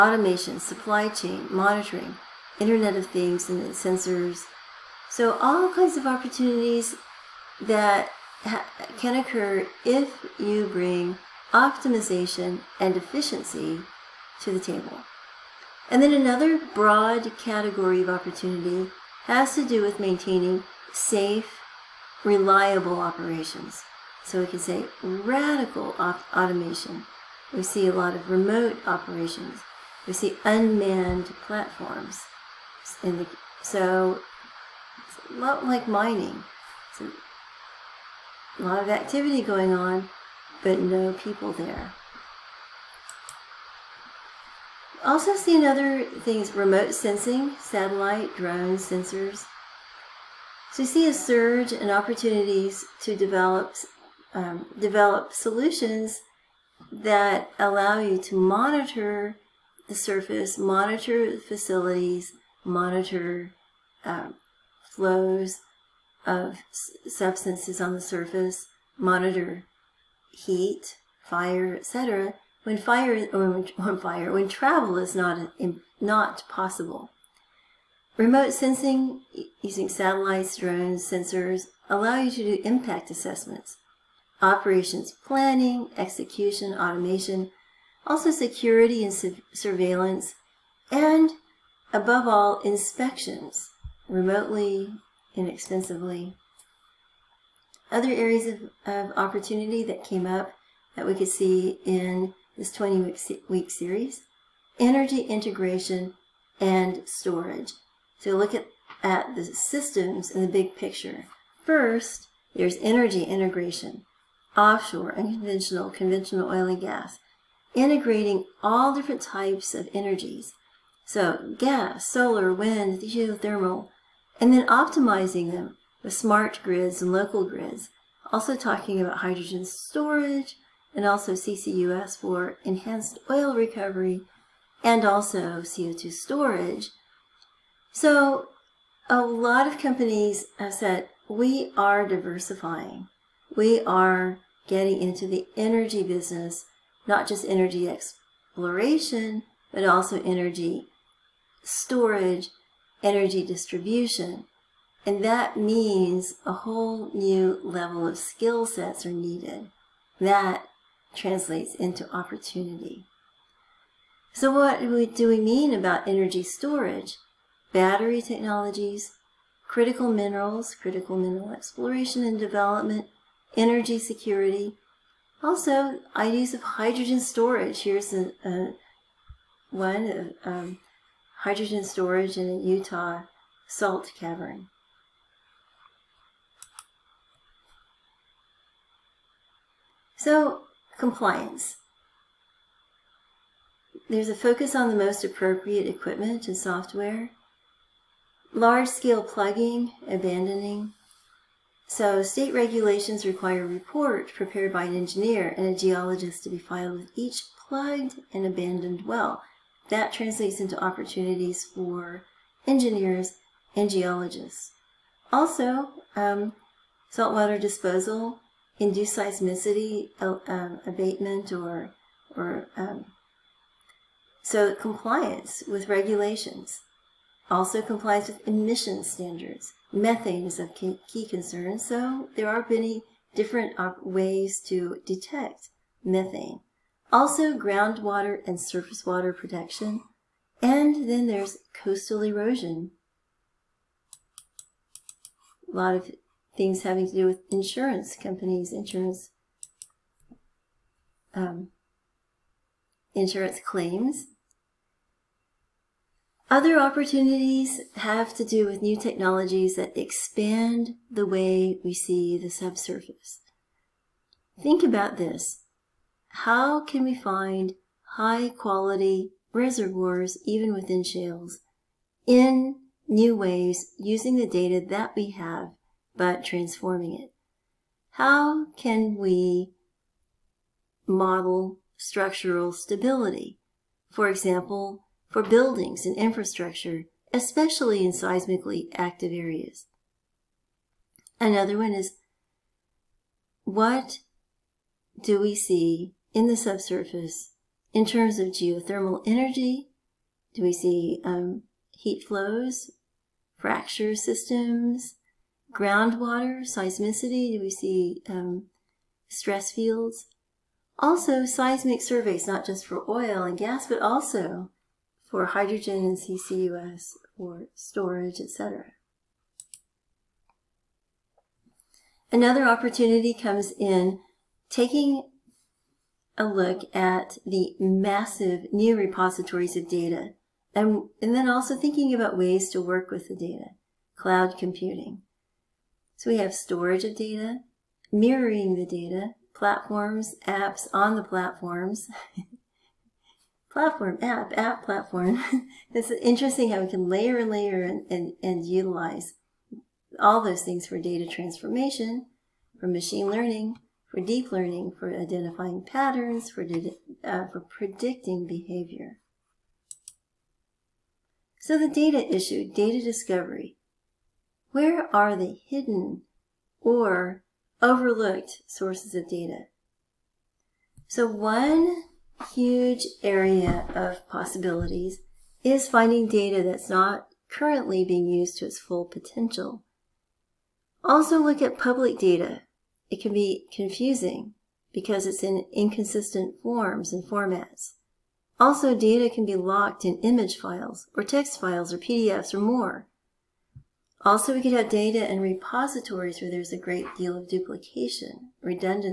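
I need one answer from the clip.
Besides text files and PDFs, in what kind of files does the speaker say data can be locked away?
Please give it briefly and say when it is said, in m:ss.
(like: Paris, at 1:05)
image files, at 6:30.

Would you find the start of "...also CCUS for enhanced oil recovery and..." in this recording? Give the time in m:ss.
2:11.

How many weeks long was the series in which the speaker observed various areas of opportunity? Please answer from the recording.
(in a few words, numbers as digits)
20.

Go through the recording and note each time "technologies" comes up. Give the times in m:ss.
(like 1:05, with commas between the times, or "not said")
2:48, 4:18.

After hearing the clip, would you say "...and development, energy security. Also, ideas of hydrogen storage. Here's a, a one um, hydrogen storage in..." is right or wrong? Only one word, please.
right.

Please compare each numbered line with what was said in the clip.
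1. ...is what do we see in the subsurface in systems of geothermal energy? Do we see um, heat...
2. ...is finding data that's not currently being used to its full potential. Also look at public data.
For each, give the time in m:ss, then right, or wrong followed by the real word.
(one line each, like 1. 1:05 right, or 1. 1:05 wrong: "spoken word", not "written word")
1. 4:51 wrong: "terms", not "systems"
2. 6:15 right.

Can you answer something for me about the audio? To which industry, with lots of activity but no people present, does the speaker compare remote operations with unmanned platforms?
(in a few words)
mining.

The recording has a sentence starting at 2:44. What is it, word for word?
So, what do we mean about energy storage?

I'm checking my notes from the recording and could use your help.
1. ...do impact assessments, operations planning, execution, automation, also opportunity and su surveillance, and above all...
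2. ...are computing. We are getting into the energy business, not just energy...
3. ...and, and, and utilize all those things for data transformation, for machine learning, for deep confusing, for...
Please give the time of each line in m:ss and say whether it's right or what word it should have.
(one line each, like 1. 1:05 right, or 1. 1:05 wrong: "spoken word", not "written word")
1. 1:22 wrong: "security", not "opportunity"
2. 2:21 wrong: "diversifying", not "computing"
3. 5:47 wrong: "learning", not "confusing".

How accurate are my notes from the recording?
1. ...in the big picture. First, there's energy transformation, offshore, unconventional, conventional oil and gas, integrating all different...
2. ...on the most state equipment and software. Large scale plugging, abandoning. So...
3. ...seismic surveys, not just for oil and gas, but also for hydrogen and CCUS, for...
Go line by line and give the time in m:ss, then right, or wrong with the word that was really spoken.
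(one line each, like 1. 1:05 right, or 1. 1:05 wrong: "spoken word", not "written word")
1. 1:50 wrong: "integration", not "transformation"
2. 3:14 wrong: "appropriate", not "state"
3. 5:11 right.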